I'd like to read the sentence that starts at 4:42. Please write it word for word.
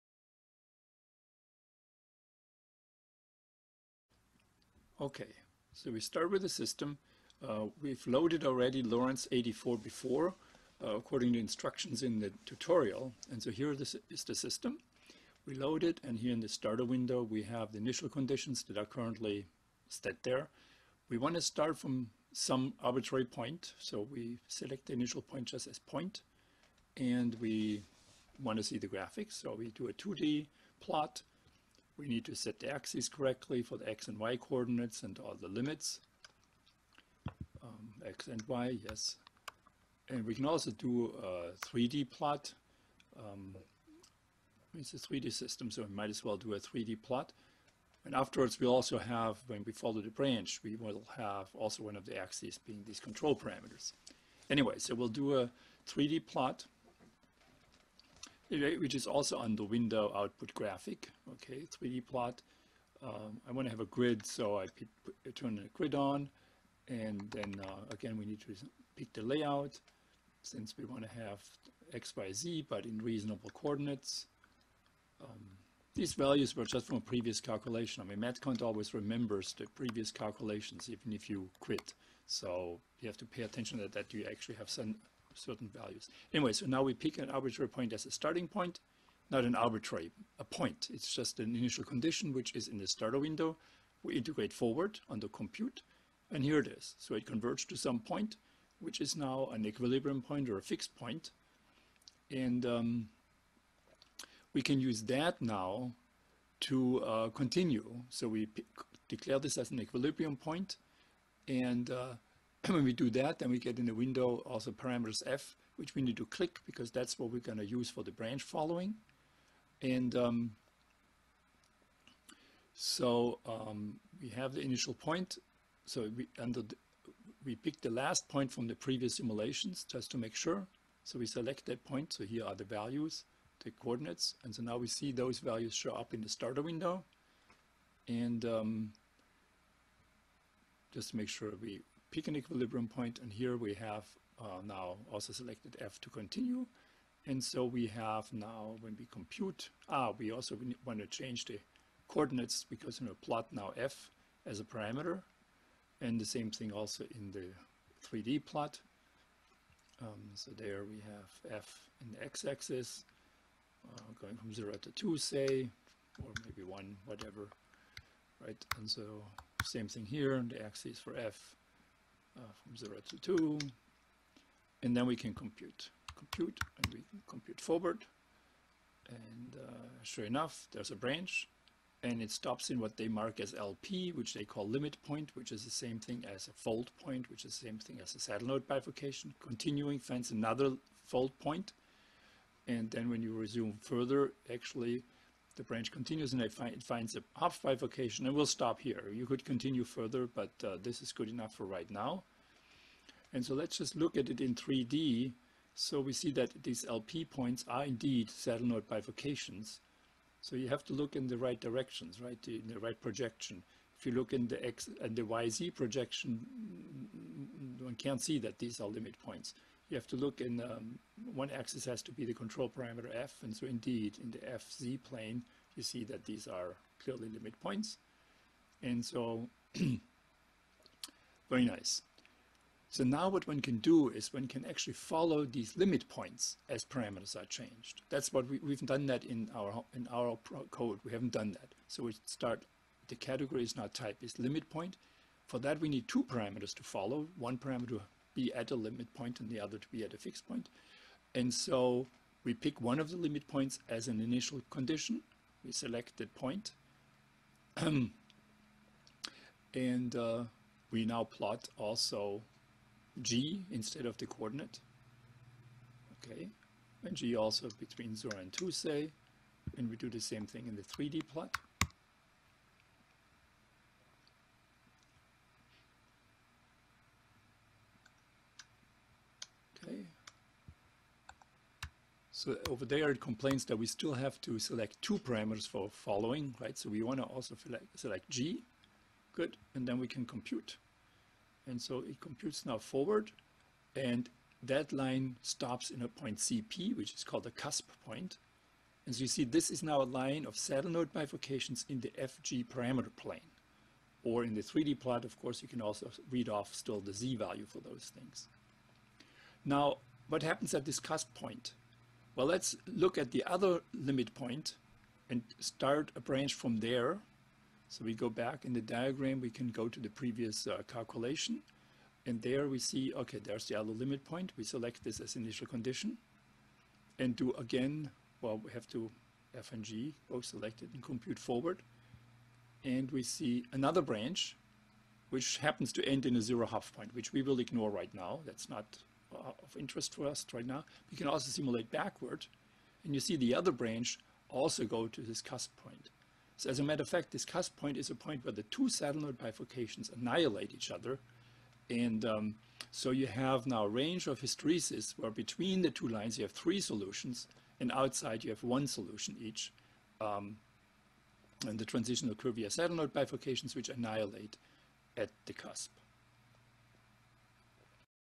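So over there, it complains that we still have to select two parameters for following, right?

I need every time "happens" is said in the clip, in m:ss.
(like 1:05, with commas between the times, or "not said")
5:10, 5:35.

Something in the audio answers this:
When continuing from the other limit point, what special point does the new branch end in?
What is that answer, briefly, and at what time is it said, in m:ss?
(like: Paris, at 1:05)
zero Hopf point, at 5:36.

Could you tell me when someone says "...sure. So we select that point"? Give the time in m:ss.
2:10.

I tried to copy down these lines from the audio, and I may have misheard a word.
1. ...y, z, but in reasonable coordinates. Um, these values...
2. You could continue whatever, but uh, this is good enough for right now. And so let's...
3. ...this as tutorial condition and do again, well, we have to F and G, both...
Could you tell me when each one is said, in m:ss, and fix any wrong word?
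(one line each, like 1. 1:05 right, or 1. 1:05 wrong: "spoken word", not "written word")
1. 1:12 right
2. 3:19 wrong: "further", not "whatever"
3. 5:25 wrong: "initial", not "tutorial".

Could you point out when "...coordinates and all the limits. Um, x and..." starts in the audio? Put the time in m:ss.
0:34.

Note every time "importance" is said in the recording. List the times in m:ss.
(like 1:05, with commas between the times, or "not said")
not said.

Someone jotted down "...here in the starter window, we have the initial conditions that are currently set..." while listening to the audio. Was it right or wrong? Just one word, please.
right.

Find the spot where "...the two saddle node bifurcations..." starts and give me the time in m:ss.
5:48.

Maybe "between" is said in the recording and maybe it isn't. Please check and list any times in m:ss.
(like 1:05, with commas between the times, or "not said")
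4:27, 5:55.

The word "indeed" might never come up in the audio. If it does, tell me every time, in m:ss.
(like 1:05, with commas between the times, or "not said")
3:27, 3:43.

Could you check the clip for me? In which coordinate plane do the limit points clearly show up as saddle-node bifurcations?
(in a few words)
fz plane.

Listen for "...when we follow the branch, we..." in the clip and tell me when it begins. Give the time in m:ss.
0:49.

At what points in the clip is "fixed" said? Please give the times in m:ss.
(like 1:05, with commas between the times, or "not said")
1:40, 4:10.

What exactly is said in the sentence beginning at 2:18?
And um, just to make sure we, peak and equilibrium point, and here we have uh, now also selected f to continue.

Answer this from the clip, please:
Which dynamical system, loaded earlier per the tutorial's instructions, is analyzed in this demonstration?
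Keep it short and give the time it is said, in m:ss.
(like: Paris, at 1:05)
Lorenz 84, at 0:08.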